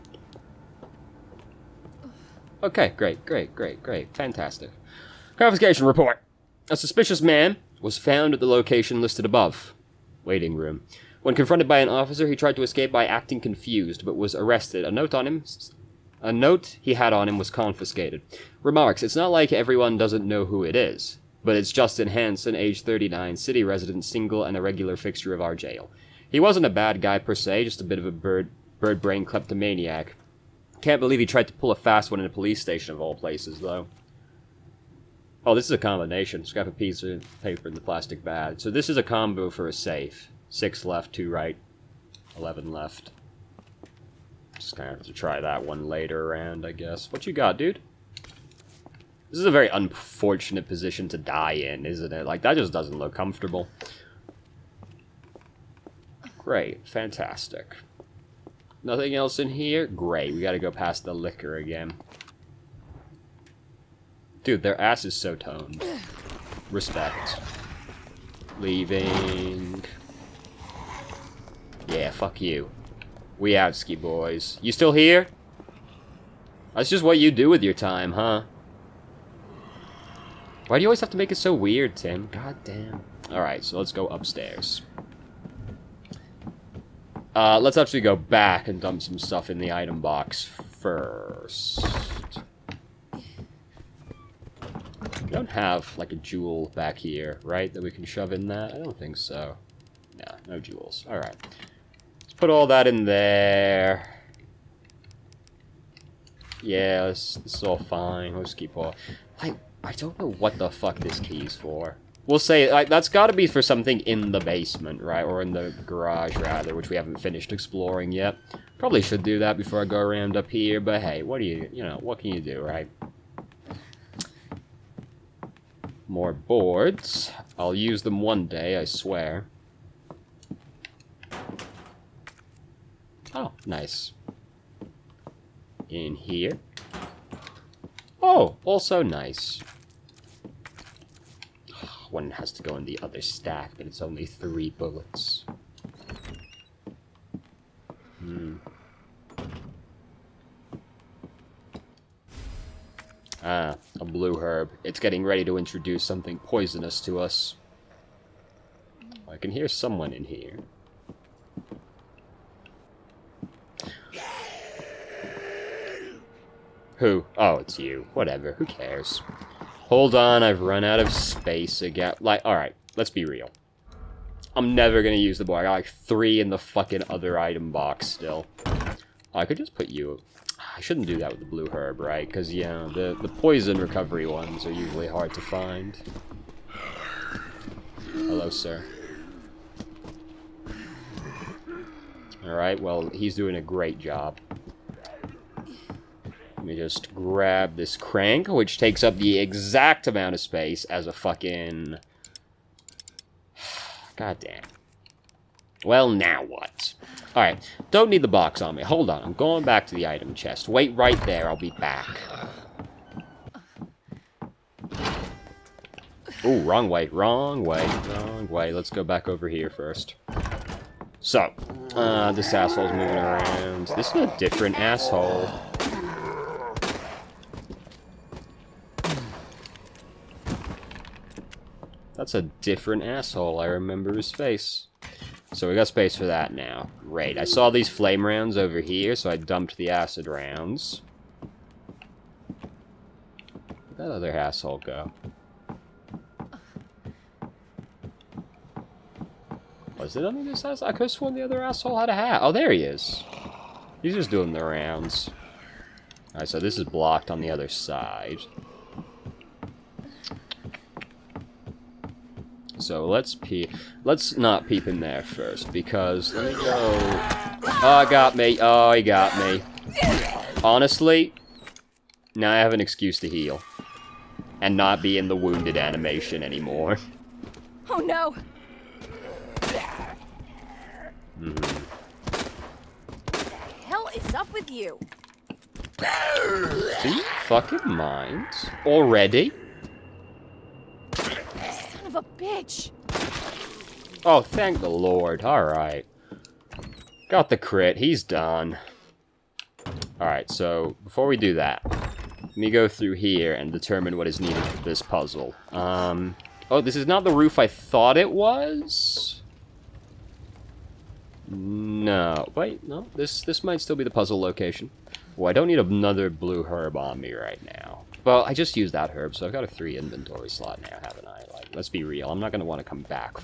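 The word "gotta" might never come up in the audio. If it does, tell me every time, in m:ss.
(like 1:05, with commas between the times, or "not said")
1:00, 1:53.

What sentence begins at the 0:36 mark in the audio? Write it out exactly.
Scrap a piece of paper in the plastic bag.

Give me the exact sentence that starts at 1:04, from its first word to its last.
Dude, their ass is so toned.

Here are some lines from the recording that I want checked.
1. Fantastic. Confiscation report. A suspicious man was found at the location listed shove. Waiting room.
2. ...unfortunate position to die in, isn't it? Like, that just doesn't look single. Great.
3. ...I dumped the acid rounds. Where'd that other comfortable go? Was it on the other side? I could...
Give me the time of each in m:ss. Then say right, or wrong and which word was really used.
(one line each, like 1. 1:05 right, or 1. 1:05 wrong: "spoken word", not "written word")
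1. 0:04 wrong: "above", not "shove"
2. 0:49 wrong: "comfortable", not "single"
3. 3:59 wrong: "asshole", not "comfortable".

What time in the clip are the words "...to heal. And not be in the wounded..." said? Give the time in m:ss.
4:33.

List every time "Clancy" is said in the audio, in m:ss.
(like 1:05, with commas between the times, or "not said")
not said.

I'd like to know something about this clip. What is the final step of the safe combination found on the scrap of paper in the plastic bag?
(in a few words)
11 left.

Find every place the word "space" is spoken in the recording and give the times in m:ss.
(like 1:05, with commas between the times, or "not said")
2:51, 3:20, 3:55.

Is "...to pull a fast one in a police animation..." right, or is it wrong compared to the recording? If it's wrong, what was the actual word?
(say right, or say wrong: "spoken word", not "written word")
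wrong: "station", not "animation".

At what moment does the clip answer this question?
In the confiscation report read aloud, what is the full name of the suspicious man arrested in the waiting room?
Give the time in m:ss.
0:21.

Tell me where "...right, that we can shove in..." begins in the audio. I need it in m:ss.
1:37.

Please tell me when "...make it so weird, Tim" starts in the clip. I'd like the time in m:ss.
1:21.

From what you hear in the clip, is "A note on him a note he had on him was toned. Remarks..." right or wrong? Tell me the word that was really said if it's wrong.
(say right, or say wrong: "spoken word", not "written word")
wrong: "confiscated", not "toned".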